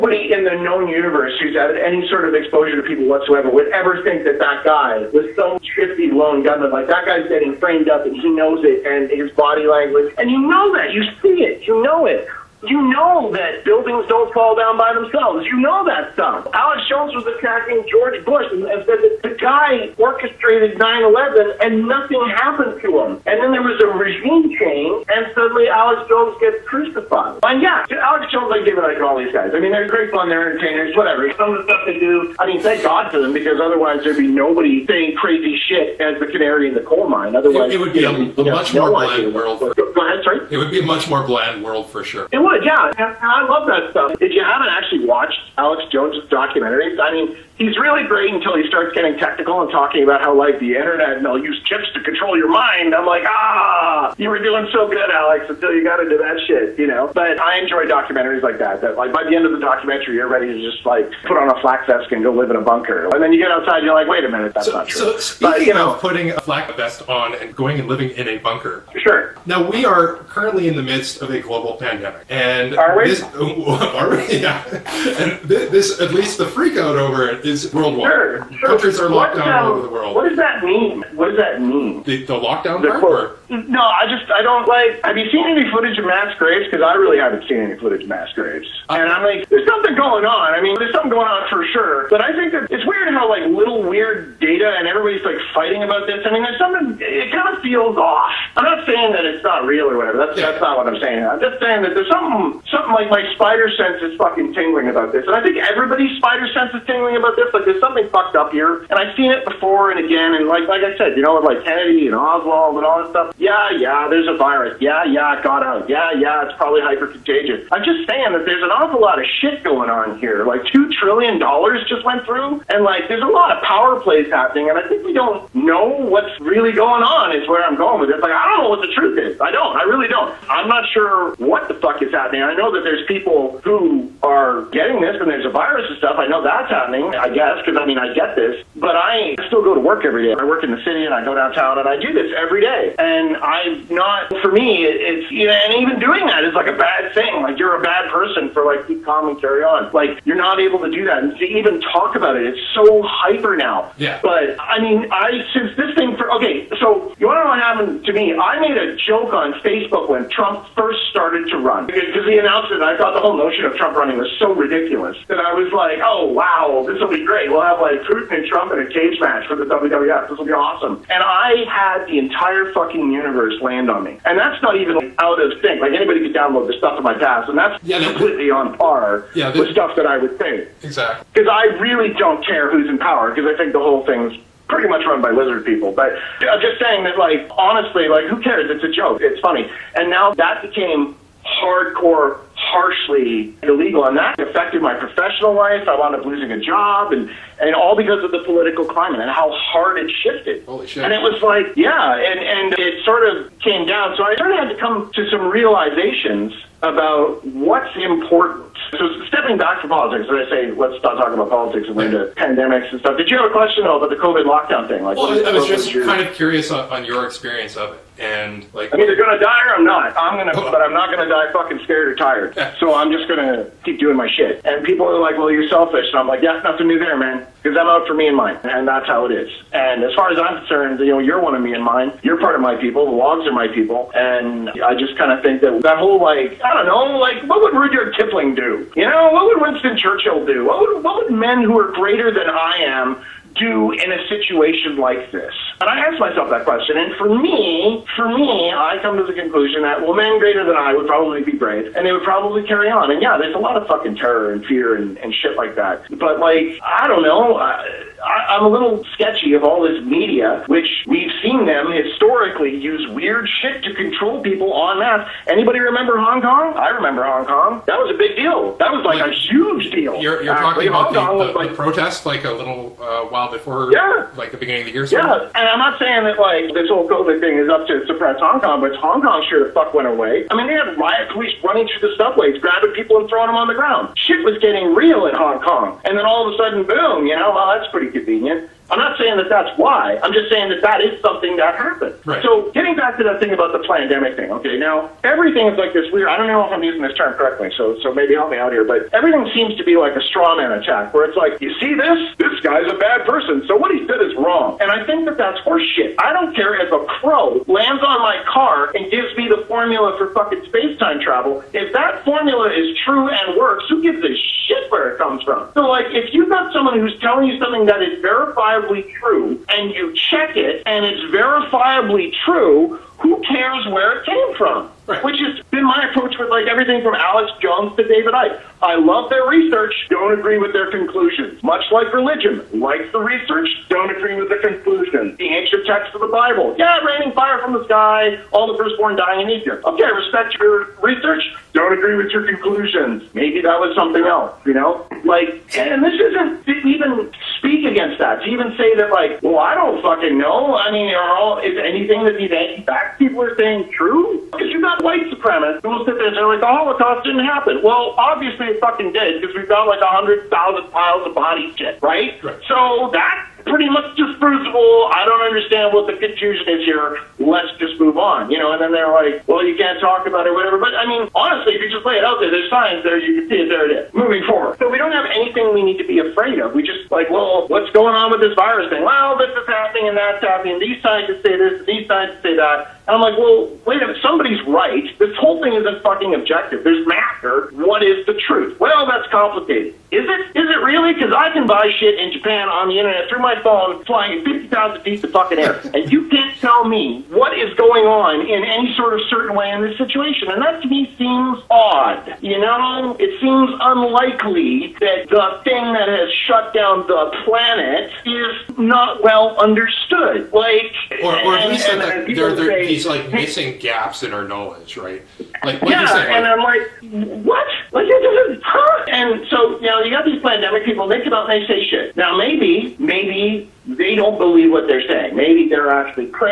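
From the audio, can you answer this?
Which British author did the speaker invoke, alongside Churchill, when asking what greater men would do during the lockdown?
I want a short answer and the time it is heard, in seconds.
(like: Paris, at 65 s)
Rudyard Kipling, at 237 s.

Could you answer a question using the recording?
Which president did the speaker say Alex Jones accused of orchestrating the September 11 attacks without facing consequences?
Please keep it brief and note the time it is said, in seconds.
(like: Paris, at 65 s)
George Bush, at 17 s.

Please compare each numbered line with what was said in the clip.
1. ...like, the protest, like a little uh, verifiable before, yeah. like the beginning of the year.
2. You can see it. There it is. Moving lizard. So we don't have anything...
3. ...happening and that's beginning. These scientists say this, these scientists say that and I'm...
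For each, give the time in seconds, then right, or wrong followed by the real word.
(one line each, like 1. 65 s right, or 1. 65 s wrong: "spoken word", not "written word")
1. 271 s wrong: "while", not "verifiable"
2. 373 s wrong: "forward", not "lizard"
3. 379 s wrong: "happening", not "beginning".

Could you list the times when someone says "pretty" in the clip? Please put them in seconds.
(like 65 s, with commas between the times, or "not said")
184 s, 287 s, 363 s.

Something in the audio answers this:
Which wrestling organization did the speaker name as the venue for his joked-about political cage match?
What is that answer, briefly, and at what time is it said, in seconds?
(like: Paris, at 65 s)
WWF, at 169 s.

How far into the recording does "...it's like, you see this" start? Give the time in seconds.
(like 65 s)
301 s.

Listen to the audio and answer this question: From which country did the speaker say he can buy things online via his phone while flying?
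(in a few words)
Japan.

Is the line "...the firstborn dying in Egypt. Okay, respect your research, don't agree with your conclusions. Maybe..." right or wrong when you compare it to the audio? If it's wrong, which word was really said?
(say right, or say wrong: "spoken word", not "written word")
right.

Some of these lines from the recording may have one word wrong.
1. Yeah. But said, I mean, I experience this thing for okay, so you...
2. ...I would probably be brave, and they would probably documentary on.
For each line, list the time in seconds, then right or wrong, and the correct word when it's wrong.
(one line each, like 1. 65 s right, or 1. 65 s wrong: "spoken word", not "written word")
1. 153 s wrong: "since", not "experience"
2. 250 s wrong: "carry", not "documentary".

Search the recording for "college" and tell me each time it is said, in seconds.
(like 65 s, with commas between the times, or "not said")
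not said.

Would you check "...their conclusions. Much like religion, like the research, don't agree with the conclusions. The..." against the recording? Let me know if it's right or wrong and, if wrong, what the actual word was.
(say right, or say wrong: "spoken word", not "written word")
right.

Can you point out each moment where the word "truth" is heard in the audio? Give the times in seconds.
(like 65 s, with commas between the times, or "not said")
128 s, 388 s.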